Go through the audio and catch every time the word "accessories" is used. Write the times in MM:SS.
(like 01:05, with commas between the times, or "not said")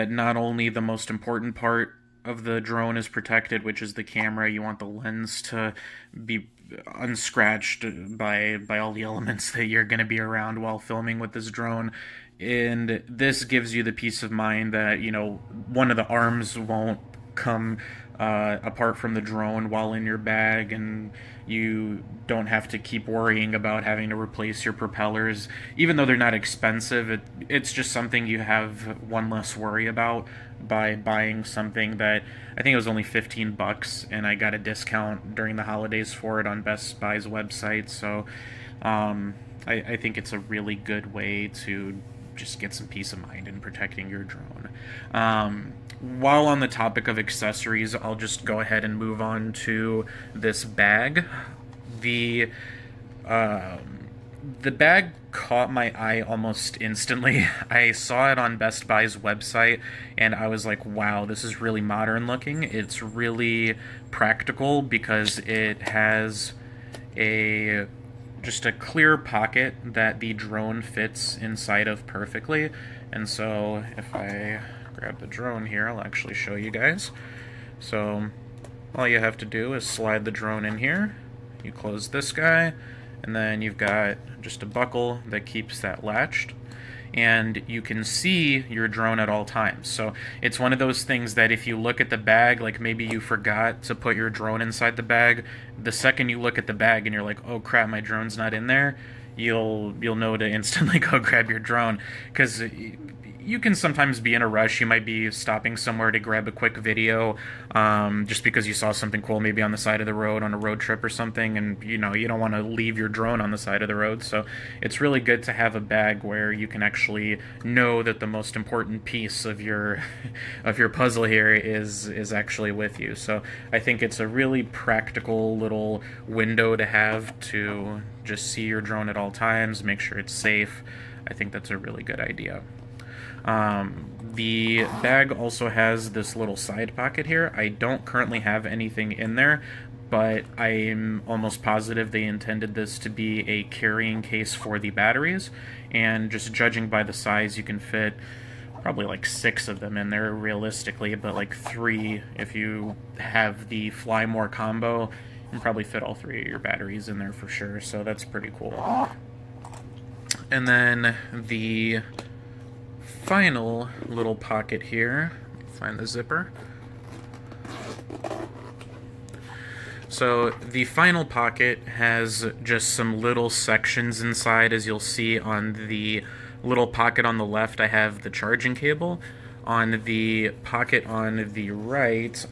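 00:47.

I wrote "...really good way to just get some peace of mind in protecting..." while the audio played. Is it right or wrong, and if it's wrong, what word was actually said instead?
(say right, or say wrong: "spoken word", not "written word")
right.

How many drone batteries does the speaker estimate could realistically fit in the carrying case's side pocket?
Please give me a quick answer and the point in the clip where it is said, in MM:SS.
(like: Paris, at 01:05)
6, at 02:29.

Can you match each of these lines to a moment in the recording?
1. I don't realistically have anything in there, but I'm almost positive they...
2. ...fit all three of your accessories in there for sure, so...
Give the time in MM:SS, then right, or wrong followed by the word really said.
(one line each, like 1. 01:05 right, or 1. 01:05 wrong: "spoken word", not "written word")
1. 02:17 wrong: "currently", not "realistically"
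2. 02:35 wrong: "batteries", not "accessories".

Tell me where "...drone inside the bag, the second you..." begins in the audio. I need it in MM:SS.
01:34.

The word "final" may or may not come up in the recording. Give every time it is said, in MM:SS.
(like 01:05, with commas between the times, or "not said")
02:43, 02:50.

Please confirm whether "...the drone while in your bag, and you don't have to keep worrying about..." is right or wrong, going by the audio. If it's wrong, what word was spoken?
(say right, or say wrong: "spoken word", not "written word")
right.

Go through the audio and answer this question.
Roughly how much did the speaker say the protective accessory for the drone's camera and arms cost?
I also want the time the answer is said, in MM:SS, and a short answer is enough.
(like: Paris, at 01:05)
$15, at 00:33.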